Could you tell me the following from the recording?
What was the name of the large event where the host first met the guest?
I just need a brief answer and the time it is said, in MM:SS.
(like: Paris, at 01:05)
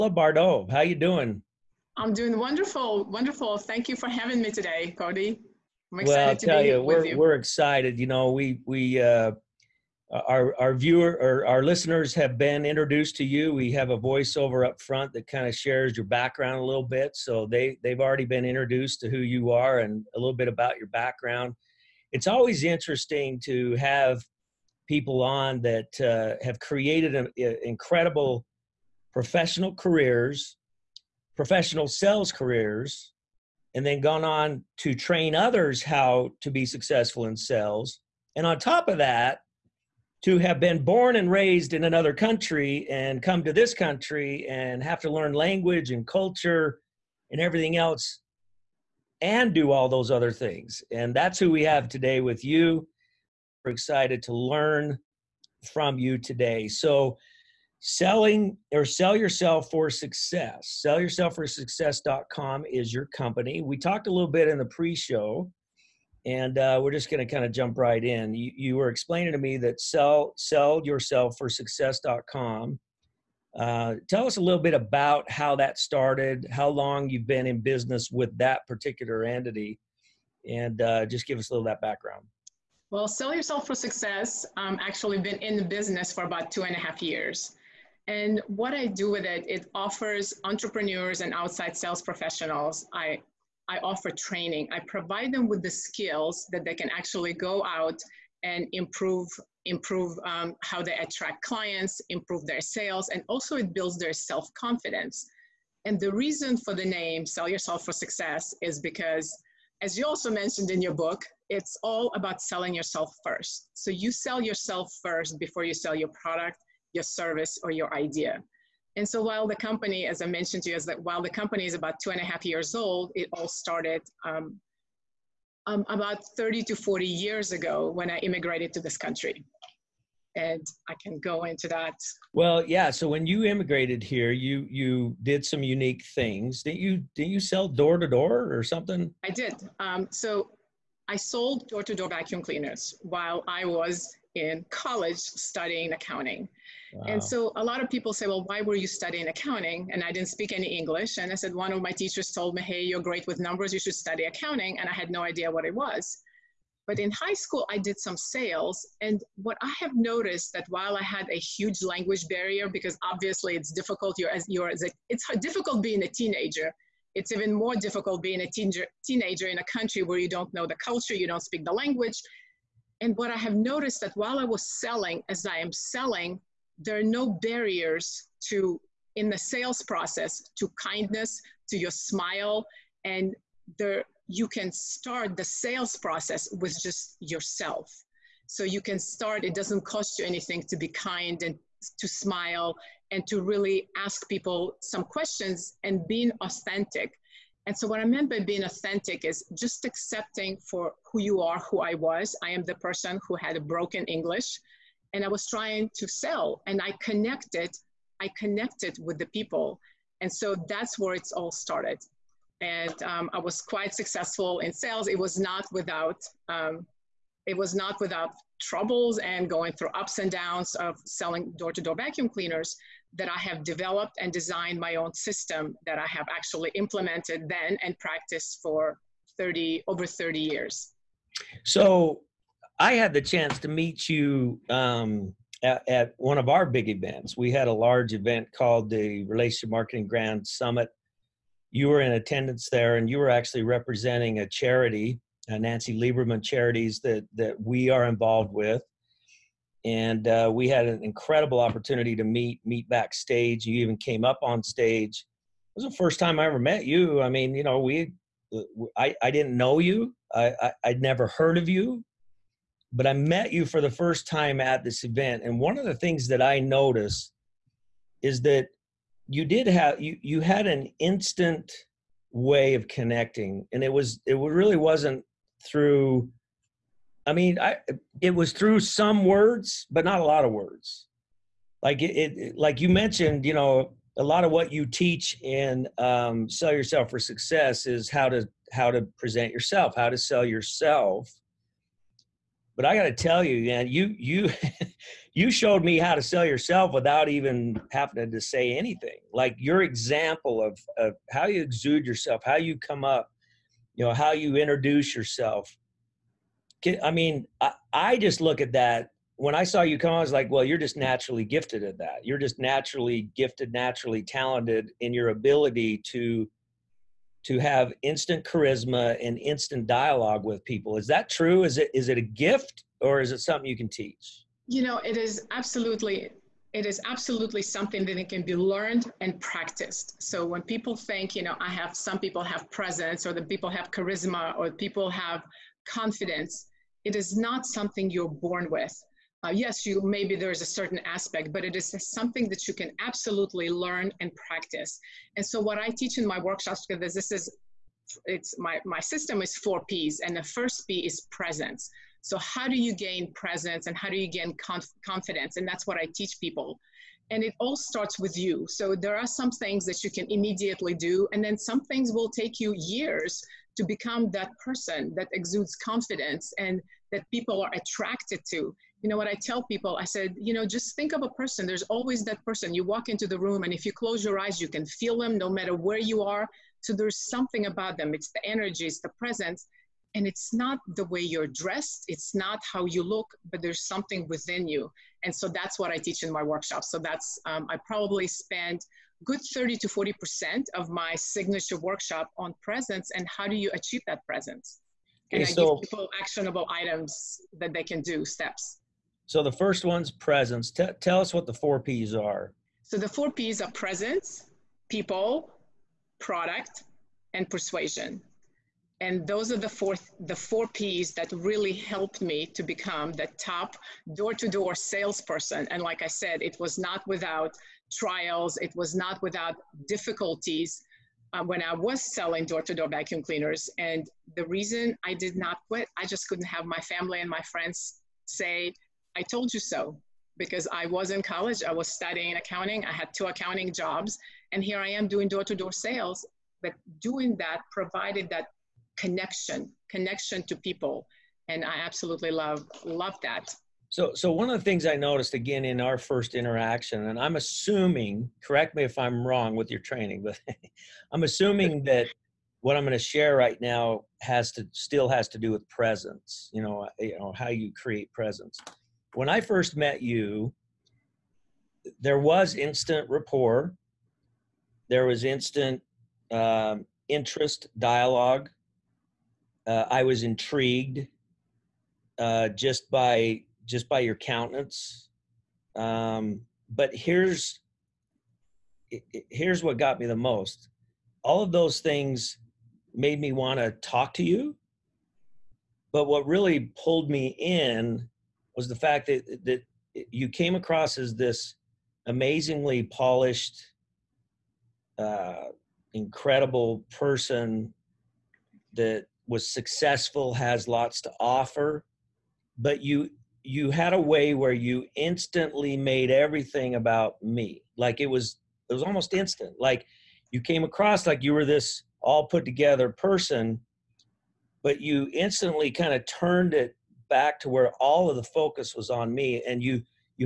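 Relationship Marketing Grand Summit, at 03:59.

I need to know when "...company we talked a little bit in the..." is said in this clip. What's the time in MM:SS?
01:03.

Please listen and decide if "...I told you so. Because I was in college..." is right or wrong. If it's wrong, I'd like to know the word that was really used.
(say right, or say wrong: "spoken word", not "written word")
right.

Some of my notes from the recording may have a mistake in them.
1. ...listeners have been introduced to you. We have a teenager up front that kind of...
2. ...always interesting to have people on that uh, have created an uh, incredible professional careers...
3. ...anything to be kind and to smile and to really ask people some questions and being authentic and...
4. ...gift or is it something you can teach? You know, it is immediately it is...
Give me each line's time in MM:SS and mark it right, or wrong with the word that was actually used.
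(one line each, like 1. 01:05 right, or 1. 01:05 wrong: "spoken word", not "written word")
1. 00:11 wrong: "voiceover", not "teenager"
2. 00:22 right
3. 03:10 right
4. 05:22 wrong: "absolutely", not "immediately".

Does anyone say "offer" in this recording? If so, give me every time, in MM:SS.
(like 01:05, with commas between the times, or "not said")
01:29, 01:33, 08:21.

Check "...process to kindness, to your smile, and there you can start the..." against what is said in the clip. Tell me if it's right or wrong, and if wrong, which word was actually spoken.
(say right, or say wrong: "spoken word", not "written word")
right.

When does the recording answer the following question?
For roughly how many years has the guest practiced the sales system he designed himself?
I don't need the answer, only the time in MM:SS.
03:49.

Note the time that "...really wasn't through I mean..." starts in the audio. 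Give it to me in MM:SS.
04:34.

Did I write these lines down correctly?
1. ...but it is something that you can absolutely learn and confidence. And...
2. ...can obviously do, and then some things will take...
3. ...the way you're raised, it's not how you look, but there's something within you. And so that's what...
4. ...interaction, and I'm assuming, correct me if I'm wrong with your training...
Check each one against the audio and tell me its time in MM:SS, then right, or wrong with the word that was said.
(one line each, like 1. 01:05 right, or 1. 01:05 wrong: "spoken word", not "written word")
1. 05:41 wrong: "practice", not "confidence"
2. 06:00 wrong: "immediately", not "obviously"
3. 06:20 wrong: "dressed", not "raised"
4. 07:26 right.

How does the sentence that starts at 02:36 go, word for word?
But in high school, I did some sales.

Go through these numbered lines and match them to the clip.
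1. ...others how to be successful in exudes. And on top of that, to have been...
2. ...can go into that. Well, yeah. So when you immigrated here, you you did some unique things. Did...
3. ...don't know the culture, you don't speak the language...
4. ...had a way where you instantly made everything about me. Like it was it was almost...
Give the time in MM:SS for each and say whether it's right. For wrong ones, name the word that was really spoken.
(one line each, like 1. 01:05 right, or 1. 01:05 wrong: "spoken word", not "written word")
1. 00:35 wrong: "sales", not "exudes"
2. 02:11 right
3. 02:50 right
4. 08:23 right.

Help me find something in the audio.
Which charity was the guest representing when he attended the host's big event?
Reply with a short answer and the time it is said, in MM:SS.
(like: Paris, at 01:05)
Nancy Lieberman Charities, at 04:05.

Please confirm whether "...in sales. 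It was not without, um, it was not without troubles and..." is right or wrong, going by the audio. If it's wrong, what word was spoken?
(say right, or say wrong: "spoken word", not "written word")
right.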